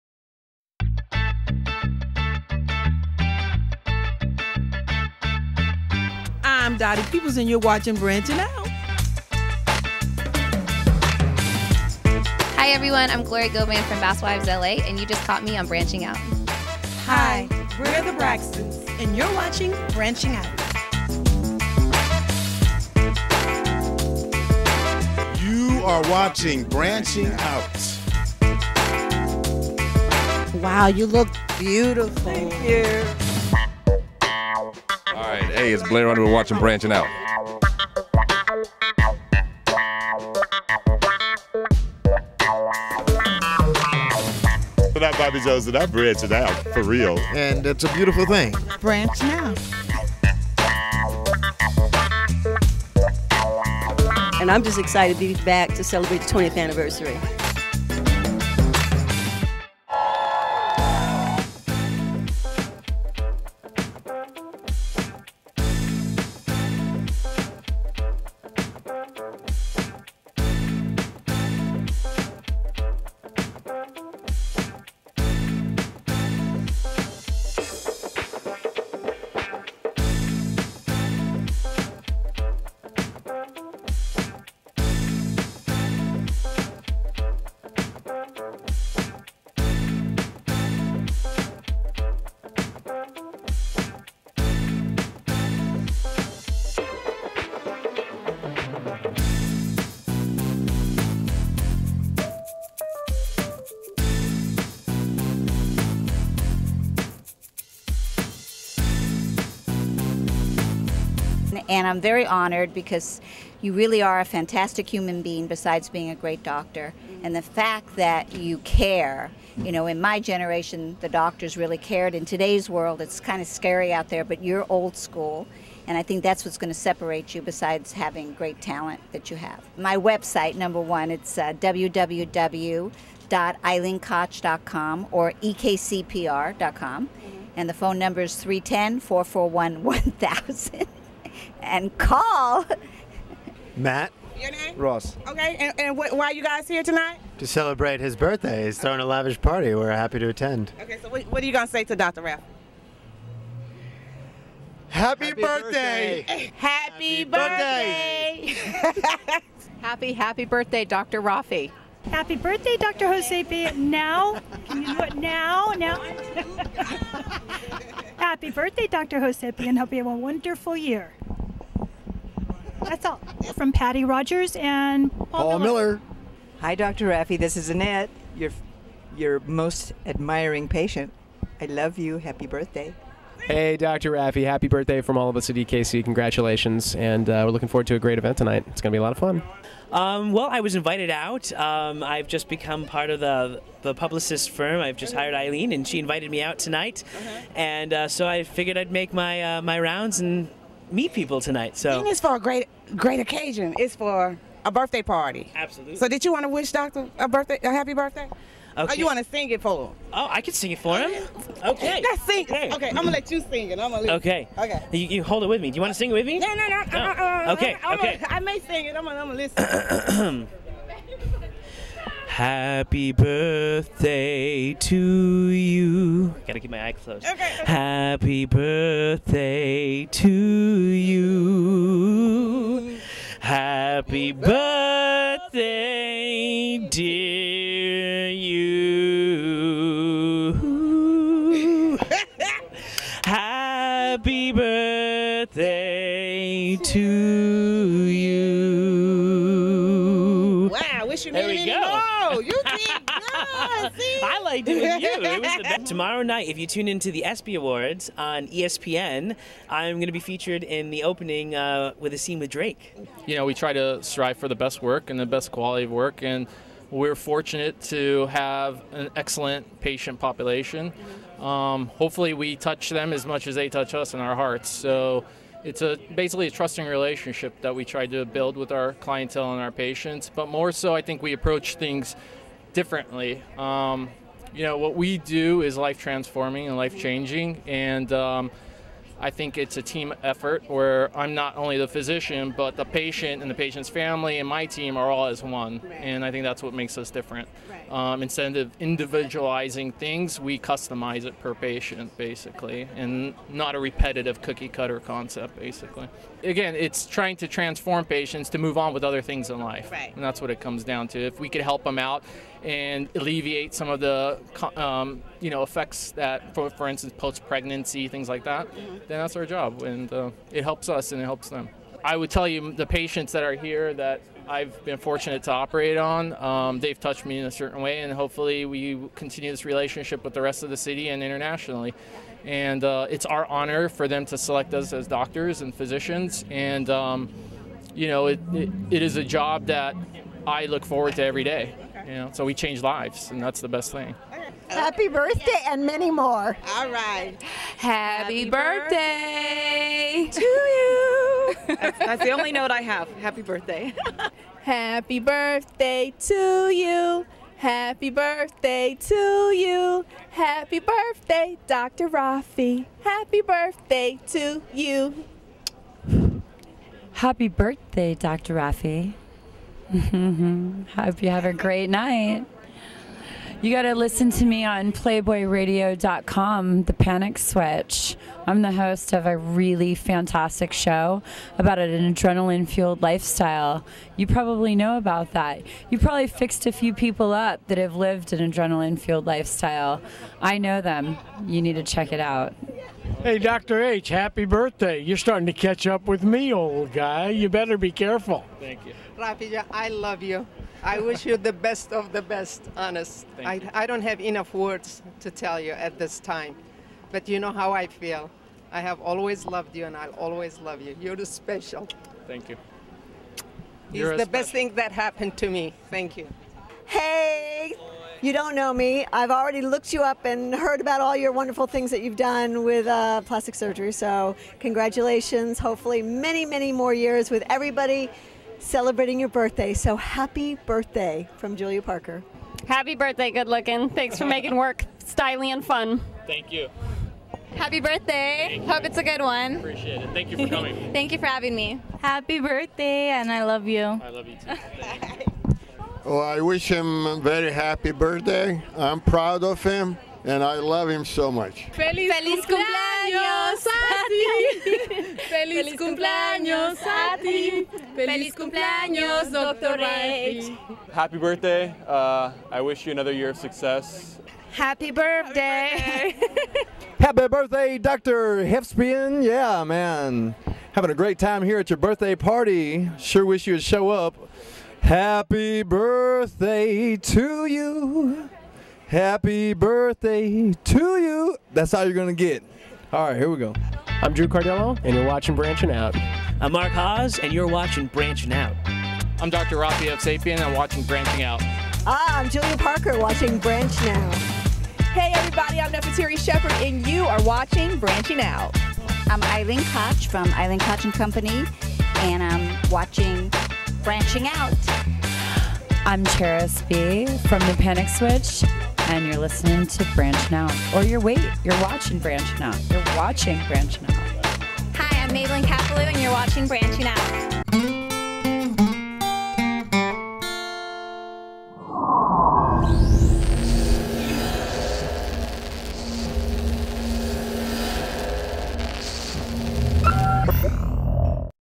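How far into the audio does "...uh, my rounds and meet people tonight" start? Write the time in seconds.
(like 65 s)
199 s.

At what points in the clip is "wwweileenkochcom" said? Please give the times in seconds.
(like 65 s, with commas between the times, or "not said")
131 s.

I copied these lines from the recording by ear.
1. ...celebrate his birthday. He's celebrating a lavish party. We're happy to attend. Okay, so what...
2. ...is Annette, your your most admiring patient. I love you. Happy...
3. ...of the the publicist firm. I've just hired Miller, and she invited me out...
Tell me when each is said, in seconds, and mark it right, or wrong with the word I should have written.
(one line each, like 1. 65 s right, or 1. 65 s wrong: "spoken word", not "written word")
1. 147 s wrong: "throwing", not "celebrating"
2. 177 s right
3. 193 s wrong: "Eileen", not "Miller".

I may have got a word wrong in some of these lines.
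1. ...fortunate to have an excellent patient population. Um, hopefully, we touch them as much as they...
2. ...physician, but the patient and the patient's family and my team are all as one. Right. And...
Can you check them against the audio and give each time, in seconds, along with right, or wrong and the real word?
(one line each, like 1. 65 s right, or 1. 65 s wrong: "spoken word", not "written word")
1. 267 s right
2. 291 s right.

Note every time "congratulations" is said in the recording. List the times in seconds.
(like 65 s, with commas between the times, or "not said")
186 s, 424 s.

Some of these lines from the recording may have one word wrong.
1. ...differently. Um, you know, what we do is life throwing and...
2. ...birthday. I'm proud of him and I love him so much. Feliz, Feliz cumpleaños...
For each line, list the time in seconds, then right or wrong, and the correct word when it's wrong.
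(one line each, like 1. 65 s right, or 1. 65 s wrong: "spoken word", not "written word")
1. 282 s wrong: "transforming", not "throwing"
2. 447 s right.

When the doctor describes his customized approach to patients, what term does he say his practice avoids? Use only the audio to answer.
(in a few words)
cookie cutter.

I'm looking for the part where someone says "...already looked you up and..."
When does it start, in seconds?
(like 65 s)
419 s.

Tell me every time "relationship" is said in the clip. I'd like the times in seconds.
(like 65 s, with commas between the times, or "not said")
276 s, 329 s.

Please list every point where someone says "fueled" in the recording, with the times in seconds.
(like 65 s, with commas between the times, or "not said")
382 s, 388 s.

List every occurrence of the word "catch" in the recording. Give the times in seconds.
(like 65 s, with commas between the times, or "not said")
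395 s.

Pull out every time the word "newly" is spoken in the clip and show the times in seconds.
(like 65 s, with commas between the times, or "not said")
not said.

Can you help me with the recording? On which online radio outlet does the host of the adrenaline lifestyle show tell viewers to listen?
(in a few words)
PlayboyRadio.com.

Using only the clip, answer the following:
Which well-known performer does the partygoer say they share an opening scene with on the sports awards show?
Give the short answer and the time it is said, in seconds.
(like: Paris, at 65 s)
Drake, at 262 s.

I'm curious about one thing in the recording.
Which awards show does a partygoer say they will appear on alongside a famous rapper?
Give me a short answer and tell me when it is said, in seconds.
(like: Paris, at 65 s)
ESPY Awards, at 257 s.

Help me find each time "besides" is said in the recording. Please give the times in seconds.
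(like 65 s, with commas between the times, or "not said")
115 s, 127 s.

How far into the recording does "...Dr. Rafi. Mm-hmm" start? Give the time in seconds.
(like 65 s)
368 s.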